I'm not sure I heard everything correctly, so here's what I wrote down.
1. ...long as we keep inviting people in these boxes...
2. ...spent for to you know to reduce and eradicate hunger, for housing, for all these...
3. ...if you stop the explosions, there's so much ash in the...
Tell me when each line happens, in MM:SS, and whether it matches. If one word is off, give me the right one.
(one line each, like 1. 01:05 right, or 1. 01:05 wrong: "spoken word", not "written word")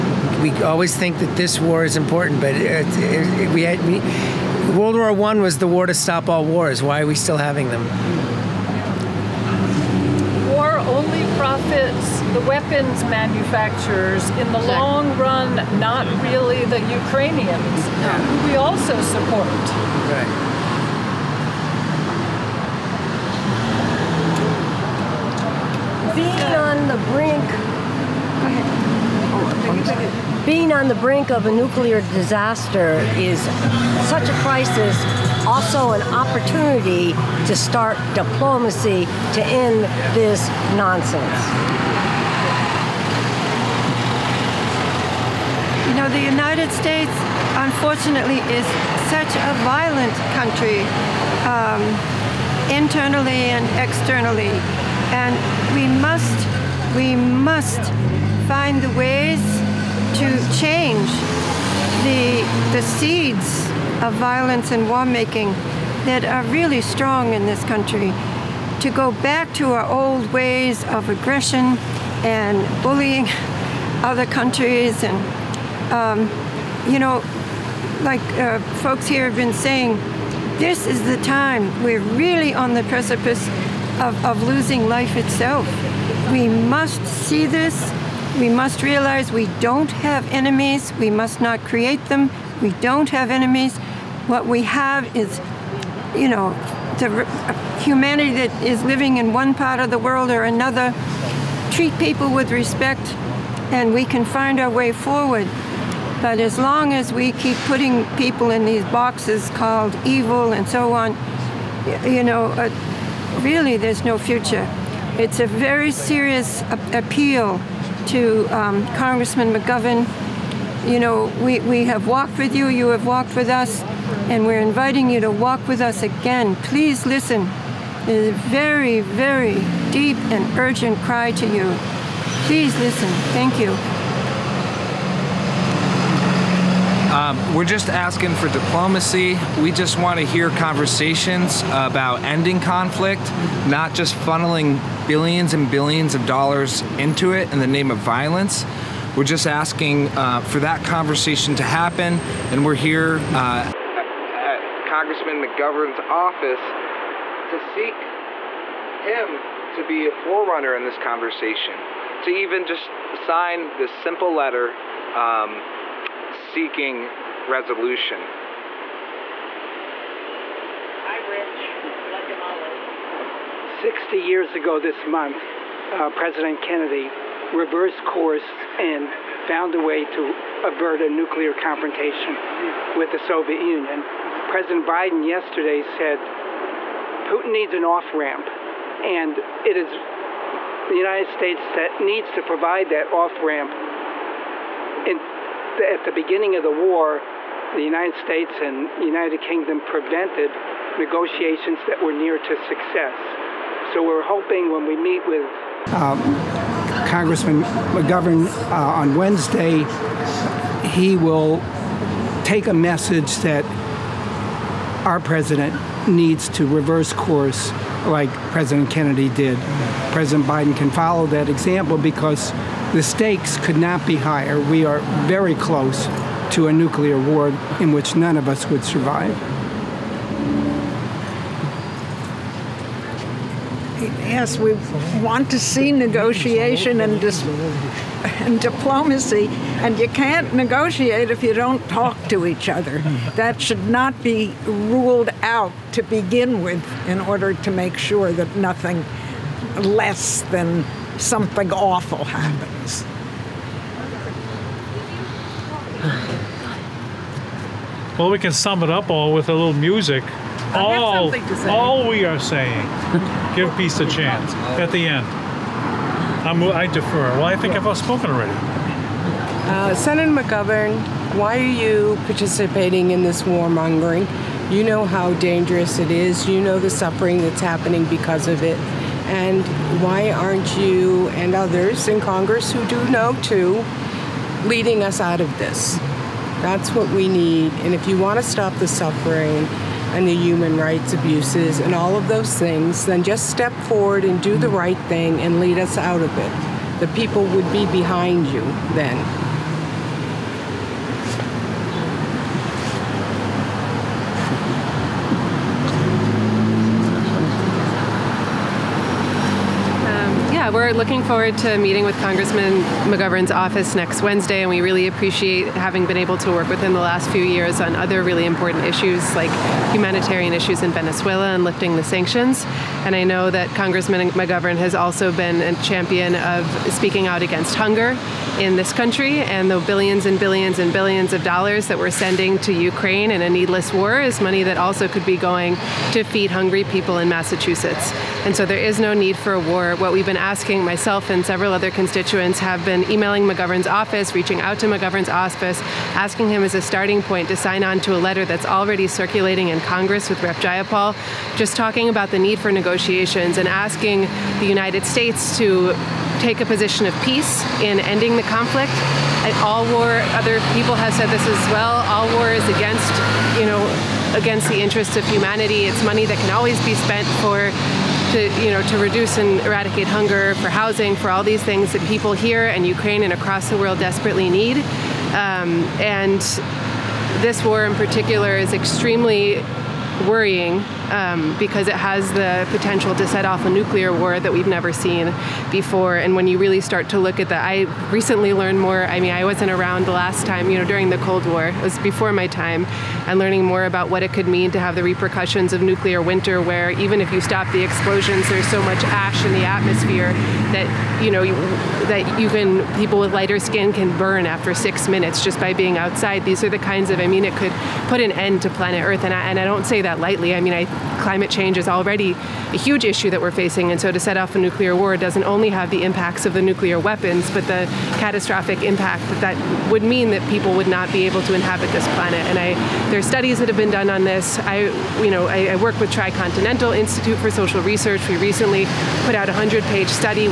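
1. 01:46 wrong: "putting", not "inviting"
2. 06:06 right
3. 06:37 right.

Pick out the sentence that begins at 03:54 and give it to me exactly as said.
Yes, we want to see negotiation and, and diplomacy, and you can't negotiate if you don't talk to each other.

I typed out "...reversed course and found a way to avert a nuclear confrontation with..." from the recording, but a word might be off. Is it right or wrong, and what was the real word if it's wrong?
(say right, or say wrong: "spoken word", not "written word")
right.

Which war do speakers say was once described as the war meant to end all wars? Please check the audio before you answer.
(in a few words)
World War One.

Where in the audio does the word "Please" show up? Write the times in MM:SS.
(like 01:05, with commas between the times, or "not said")
02:06, 02:12.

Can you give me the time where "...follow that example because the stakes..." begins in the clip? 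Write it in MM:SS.
03:40.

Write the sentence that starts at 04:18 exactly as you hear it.
Well, we can sum it up all with a little music.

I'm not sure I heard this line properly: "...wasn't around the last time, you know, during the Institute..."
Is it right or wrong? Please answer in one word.
wrong.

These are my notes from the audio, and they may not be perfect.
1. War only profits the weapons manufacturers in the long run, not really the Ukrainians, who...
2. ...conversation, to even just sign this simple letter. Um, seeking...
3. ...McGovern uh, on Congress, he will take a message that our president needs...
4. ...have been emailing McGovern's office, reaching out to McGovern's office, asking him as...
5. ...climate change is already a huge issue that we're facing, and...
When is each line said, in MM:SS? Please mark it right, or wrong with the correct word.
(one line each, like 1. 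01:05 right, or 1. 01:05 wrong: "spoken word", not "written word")
1. 00:10 right
2. 02:40 right
3. 03:27 wrong: "Wednesday", not "Congress"
4. 05:42 right
5. 06:51 right.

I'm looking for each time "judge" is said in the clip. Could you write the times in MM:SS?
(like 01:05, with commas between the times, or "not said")
not said.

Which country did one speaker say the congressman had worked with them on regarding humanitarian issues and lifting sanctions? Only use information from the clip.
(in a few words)
Venezuela.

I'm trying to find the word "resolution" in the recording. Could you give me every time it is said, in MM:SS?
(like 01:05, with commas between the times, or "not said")
02:47.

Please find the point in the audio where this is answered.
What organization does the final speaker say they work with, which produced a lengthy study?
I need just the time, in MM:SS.
07:06.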